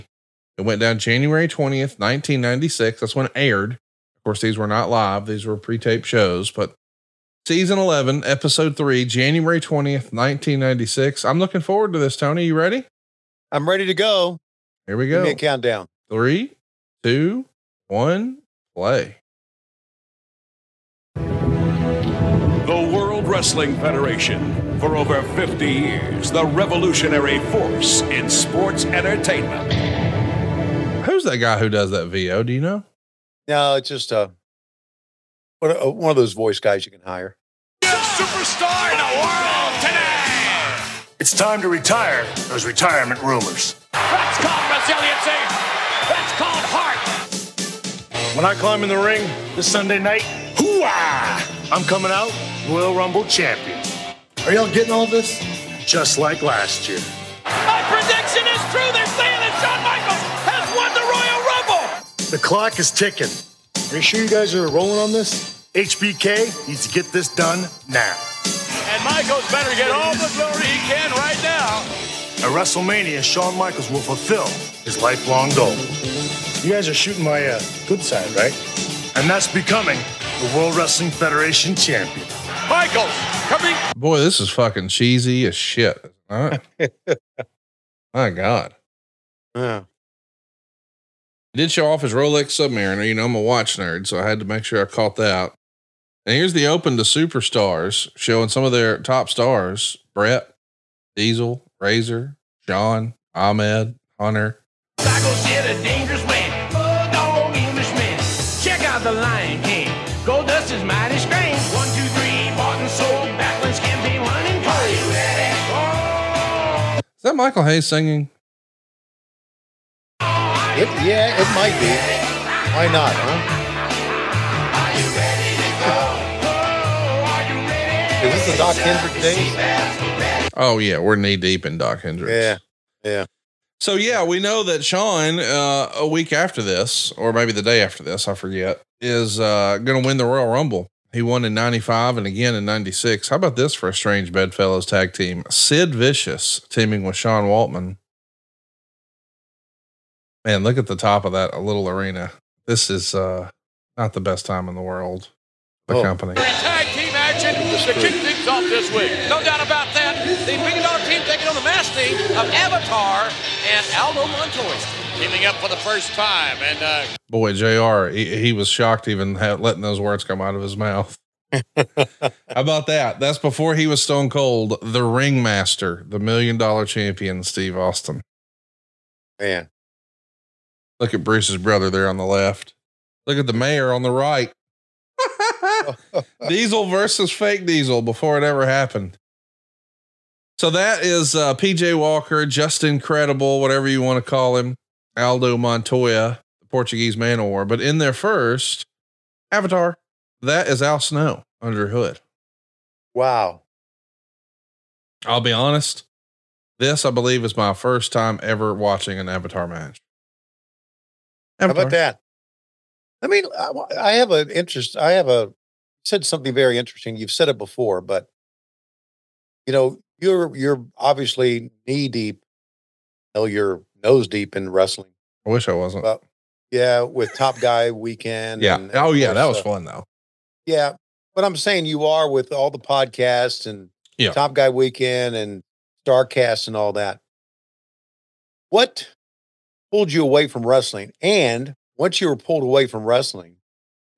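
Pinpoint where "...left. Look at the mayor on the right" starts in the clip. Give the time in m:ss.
3:02.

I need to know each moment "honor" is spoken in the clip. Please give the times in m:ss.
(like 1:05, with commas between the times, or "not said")
not said.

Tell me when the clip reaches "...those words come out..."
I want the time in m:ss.
2:49.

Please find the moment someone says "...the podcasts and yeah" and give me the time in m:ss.
3:52.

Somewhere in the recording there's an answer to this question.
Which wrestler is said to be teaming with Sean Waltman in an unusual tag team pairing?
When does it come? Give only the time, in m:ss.
2:25.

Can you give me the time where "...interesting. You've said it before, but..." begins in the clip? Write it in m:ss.
3:36.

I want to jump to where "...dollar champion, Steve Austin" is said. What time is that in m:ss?
2:56.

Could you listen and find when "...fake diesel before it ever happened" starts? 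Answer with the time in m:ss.
3:07.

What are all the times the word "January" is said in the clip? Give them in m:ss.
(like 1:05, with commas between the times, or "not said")
0:00, 0:09.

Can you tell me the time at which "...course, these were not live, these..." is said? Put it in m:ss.
0:04.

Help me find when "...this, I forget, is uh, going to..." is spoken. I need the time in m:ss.
2:18.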